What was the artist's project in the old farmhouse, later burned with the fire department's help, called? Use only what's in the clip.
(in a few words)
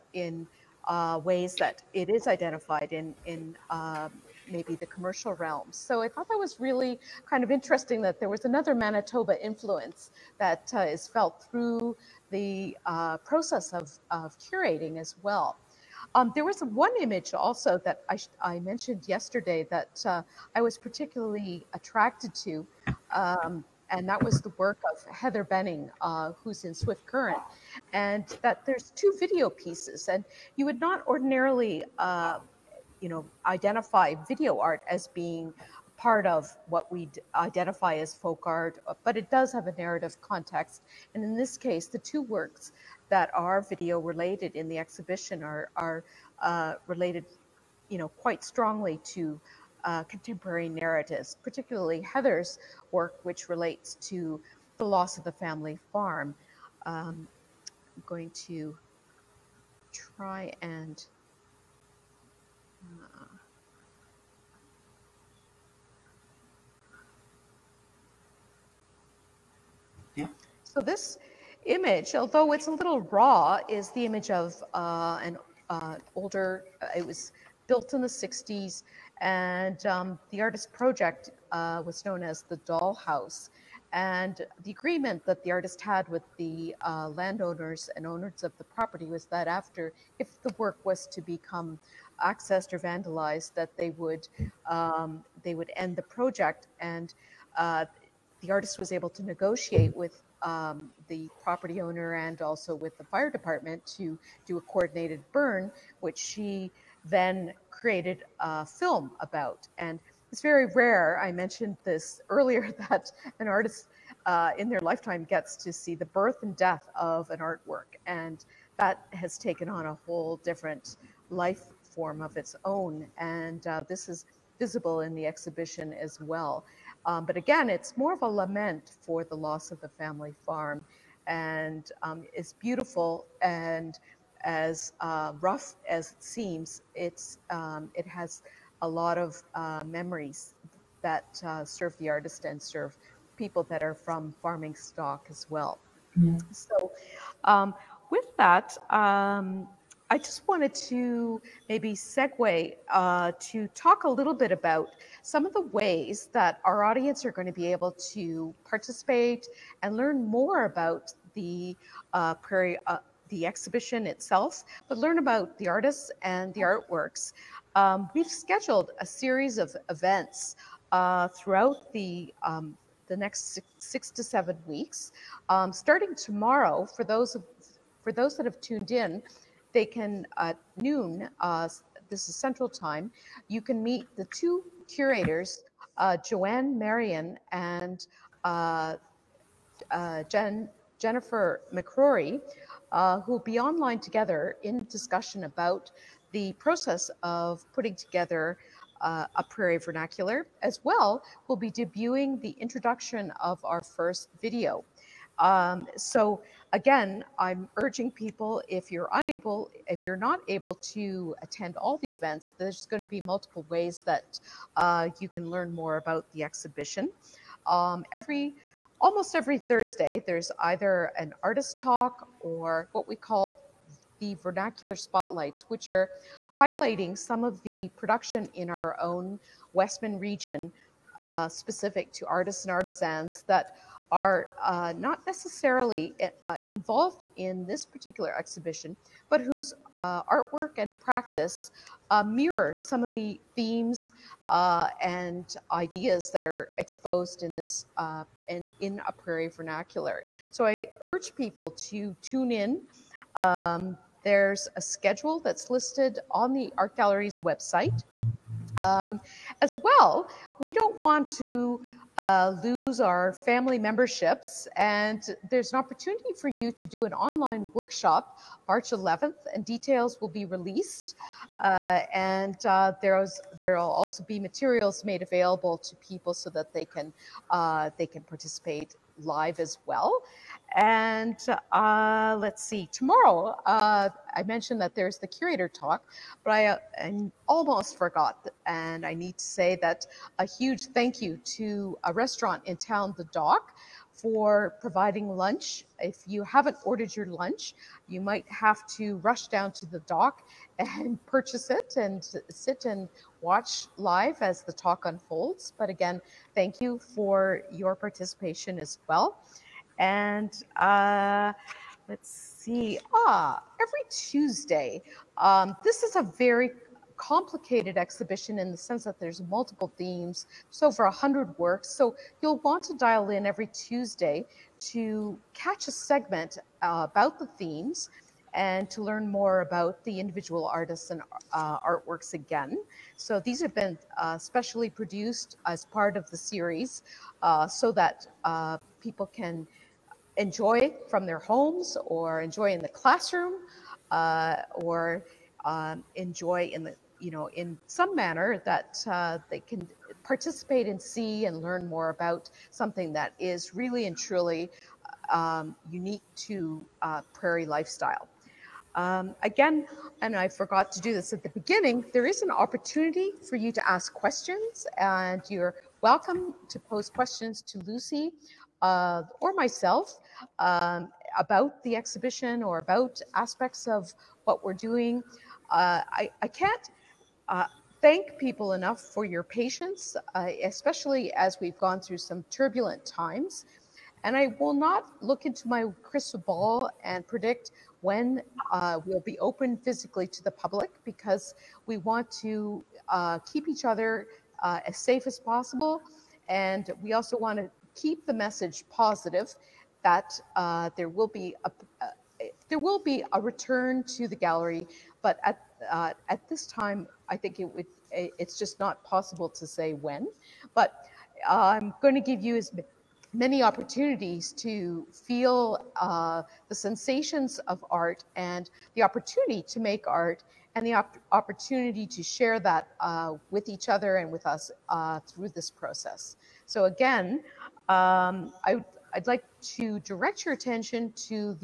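The Dollhouse.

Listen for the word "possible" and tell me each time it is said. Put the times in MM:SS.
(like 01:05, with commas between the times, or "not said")
06:35, 06:49.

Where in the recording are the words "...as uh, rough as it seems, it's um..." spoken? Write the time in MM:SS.
02:14.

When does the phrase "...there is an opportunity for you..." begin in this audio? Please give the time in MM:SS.
06:02.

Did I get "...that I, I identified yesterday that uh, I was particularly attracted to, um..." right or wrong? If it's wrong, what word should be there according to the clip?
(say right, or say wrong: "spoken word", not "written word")
wrong: "mentioned", not "identified".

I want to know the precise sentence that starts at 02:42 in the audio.
Uh, the exhibition itself, but learn about the artists and the artworks.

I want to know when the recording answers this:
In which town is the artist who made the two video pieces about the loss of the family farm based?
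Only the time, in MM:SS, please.
00:26.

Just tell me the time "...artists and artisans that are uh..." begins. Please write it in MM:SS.
03:52.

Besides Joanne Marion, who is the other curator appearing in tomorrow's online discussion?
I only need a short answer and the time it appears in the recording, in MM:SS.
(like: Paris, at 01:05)
Jennifer McRorie, at 03:10.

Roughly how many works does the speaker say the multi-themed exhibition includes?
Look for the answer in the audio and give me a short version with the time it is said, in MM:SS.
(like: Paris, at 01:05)
over 100, at 05:20.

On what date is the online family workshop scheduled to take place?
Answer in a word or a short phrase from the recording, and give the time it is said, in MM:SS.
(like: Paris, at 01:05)
March 11, at 04:28.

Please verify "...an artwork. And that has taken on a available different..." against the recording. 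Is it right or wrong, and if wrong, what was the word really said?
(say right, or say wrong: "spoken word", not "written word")
wrong: "whole", not "available".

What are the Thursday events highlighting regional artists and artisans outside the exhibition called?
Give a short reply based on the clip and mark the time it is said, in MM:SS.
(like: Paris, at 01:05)
vernacular spotlights, at 03:44.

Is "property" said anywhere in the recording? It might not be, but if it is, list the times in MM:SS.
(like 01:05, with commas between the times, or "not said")
01:28, 01:41.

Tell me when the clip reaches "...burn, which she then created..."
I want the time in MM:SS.
01:45.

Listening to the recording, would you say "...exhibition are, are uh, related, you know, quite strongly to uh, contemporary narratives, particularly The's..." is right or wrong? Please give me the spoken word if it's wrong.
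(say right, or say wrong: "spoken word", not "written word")
wrong: "Heather", not "The".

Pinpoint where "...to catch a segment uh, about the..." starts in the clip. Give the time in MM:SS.
05:24.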